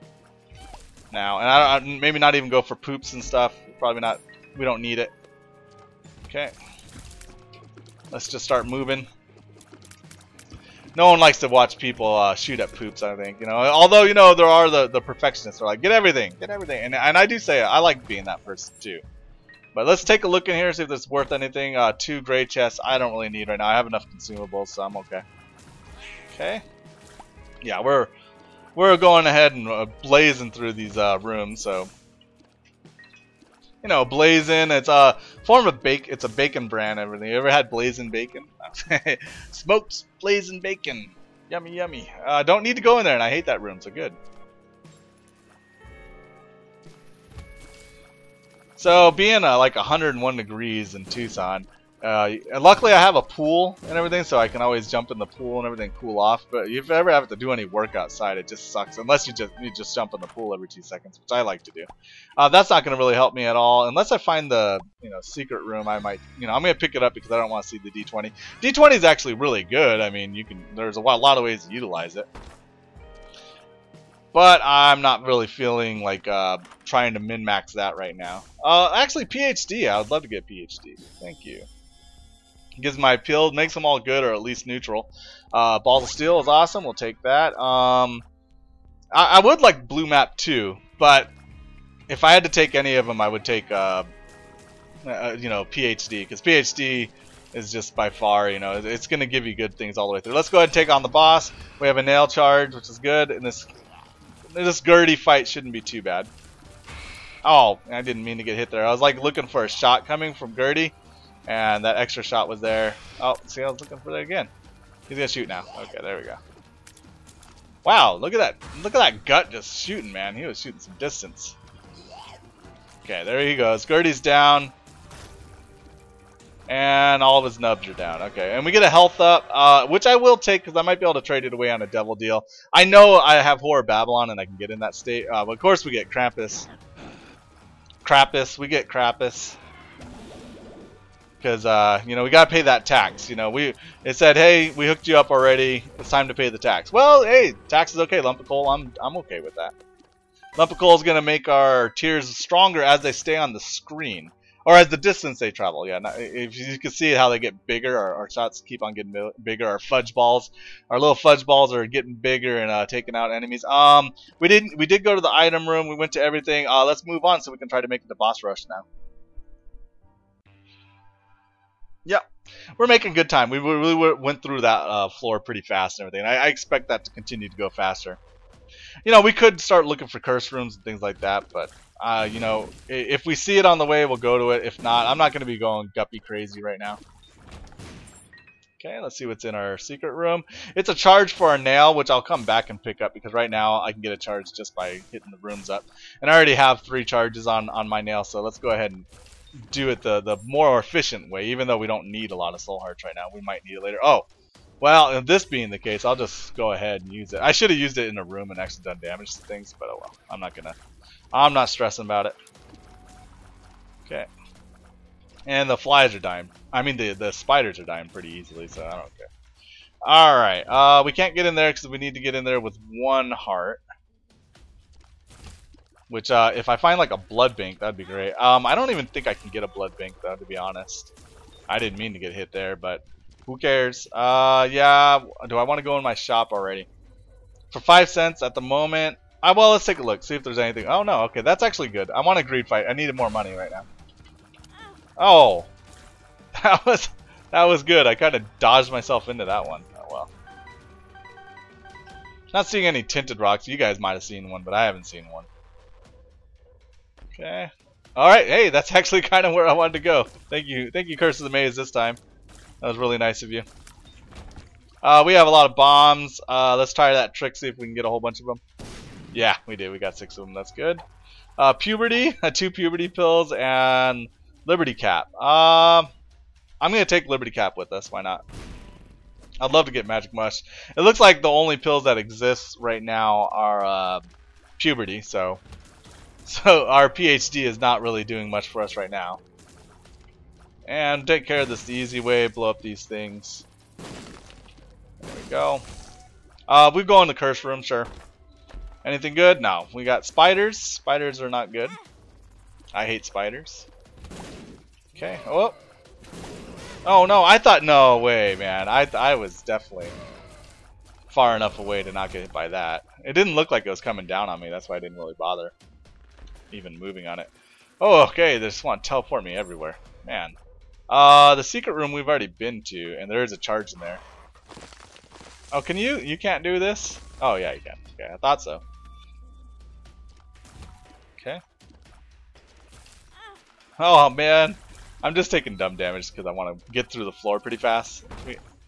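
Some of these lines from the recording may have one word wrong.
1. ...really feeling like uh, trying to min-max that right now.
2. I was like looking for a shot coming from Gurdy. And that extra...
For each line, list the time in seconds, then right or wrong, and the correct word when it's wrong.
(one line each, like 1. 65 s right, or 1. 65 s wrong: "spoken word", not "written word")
1. 75 s right
2. 108 s right.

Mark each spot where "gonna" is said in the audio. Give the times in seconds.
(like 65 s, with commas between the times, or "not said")
115 s, 151 s, 210 s.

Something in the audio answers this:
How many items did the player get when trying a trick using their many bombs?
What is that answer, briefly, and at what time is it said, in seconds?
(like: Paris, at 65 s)
6, at 270 s.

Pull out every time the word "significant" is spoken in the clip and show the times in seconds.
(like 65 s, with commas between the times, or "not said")
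not said.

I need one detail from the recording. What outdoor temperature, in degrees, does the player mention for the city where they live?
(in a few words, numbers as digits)
101.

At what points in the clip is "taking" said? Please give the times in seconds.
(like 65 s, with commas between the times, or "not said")
162 s, 335 s.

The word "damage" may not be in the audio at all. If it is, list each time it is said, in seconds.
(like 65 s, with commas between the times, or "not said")
209 s, 335 s.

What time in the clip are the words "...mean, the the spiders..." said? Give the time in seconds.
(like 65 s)
216 s.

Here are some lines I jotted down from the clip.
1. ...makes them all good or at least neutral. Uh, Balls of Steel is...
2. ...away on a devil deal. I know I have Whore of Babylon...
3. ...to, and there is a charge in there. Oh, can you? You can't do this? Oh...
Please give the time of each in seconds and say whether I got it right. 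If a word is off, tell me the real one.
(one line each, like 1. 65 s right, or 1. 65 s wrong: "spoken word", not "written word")
1. 83 s right
2. 131 s right
3. 322 s right.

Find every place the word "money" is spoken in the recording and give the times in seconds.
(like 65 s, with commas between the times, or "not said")
243 s.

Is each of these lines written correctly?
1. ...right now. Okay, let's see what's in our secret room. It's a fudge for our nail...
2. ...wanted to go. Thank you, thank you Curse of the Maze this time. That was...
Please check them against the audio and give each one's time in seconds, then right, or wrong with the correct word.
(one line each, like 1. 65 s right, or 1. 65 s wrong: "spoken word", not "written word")
1. 186 s wrong: "charge", not "fudge"
2. 259 s right.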